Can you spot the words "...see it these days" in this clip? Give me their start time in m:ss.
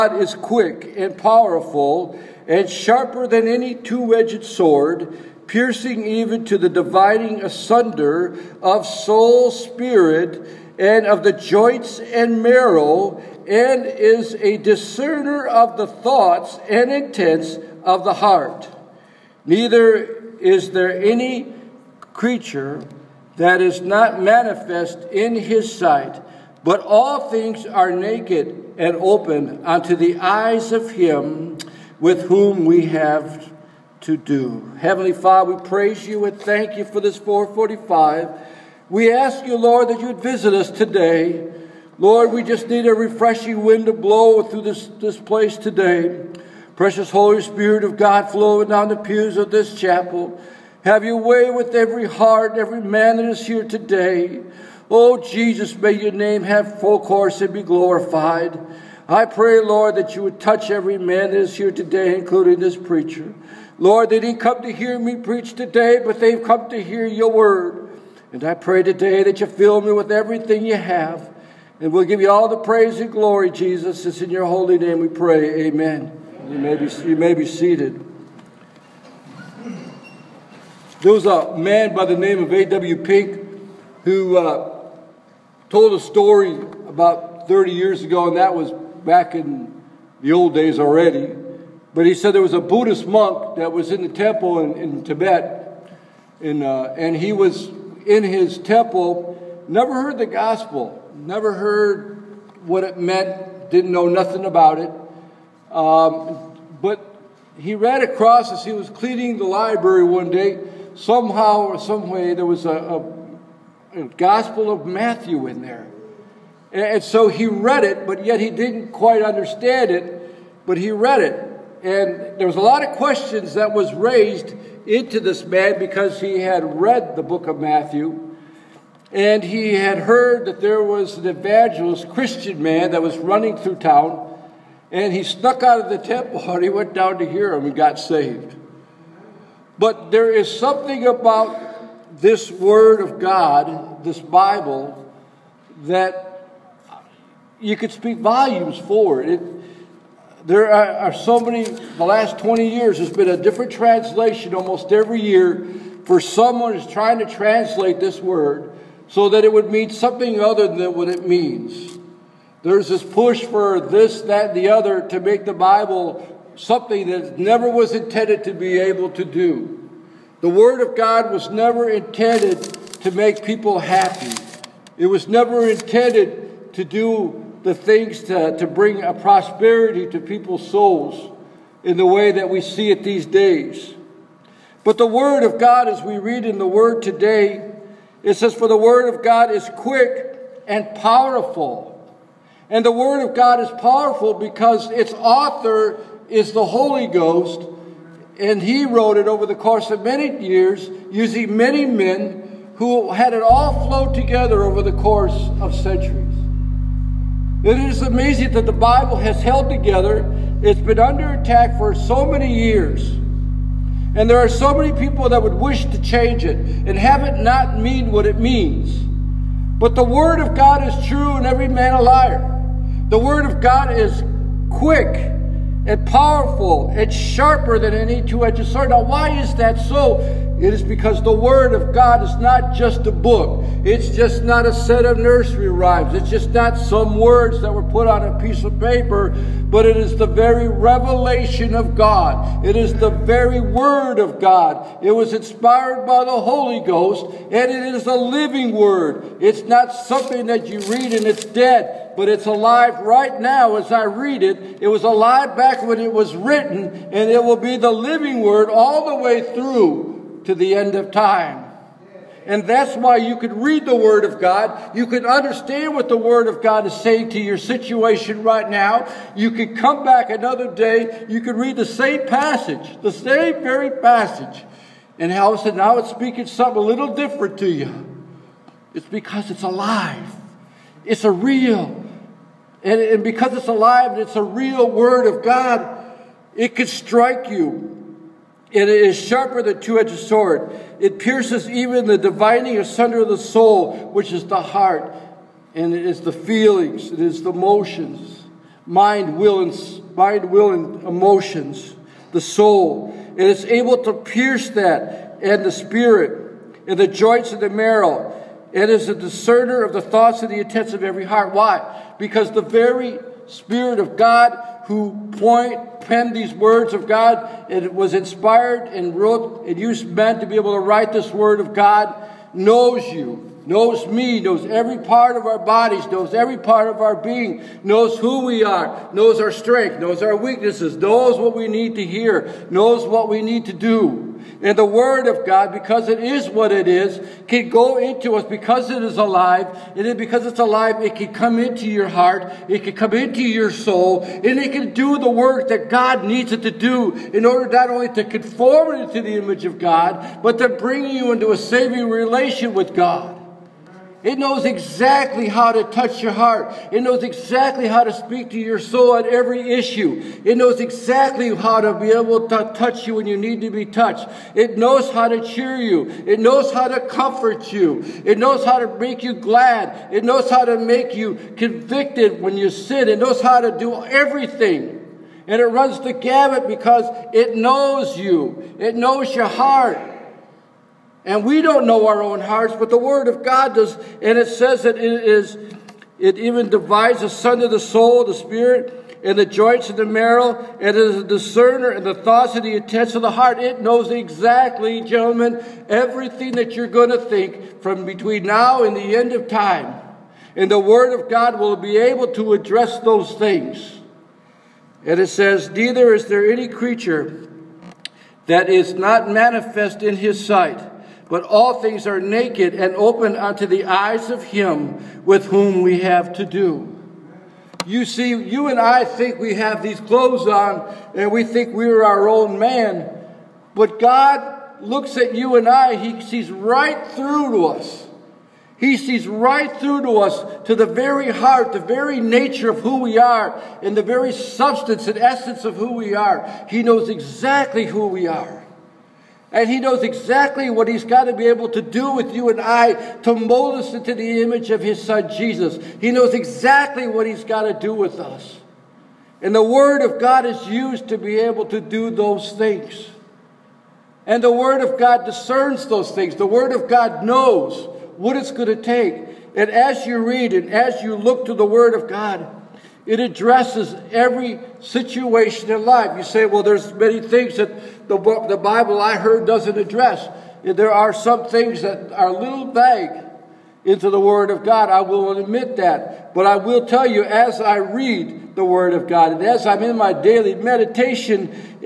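3:02.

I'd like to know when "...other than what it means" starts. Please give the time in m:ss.
2:40.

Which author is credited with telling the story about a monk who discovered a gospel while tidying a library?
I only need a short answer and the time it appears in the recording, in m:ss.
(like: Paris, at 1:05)
A.W. Pink, at 1:22.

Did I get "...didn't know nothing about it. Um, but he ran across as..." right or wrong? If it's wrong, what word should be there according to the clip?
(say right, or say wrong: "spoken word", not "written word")
right.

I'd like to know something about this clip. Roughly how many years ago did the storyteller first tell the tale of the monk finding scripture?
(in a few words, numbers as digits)
30.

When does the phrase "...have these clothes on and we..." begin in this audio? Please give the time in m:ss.
6:59.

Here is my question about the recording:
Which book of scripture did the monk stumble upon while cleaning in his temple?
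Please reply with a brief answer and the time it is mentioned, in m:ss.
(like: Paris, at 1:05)
Gospel of Matthew, at 1:54.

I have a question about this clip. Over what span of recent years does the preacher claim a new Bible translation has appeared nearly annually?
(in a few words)
20 years.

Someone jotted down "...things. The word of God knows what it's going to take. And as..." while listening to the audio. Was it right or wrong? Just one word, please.
right.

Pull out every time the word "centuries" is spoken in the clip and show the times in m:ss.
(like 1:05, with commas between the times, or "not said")
3:25.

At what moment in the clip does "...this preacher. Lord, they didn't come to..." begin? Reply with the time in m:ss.
1:02.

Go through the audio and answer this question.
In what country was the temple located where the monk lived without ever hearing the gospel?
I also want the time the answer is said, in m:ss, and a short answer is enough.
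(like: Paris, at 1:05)
Tibet, at 1:35.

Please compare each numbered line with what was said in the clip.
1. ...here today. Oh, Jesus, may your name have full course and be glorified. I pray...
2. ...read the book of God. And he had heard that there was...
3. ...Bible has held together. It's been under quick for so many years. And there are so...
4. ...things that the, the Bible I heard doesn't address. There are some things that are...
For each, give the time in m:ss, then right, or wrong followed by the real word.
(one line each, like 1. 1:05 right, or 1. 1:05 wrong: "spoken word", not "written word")
1. 0:53 right
2. 2:06 wrong: "Matthew", not "God"
3. 3:28 wrong: "attack", not "quick"
4. 7:47 right.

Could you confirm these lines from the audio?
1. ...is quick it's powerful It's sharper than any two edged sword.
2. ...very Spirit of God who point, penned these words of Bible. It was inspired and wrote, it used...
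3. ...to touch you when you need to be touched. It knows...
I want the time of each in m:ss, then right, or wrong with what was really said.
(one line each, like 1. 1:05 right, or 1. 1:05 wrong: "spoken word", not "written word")
1. 3:43 right
2. 5:12 wrong: "God", not "Bible"
3. 6:02 right.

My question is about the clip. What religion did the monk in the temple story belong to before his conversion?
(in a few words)
Buddhist.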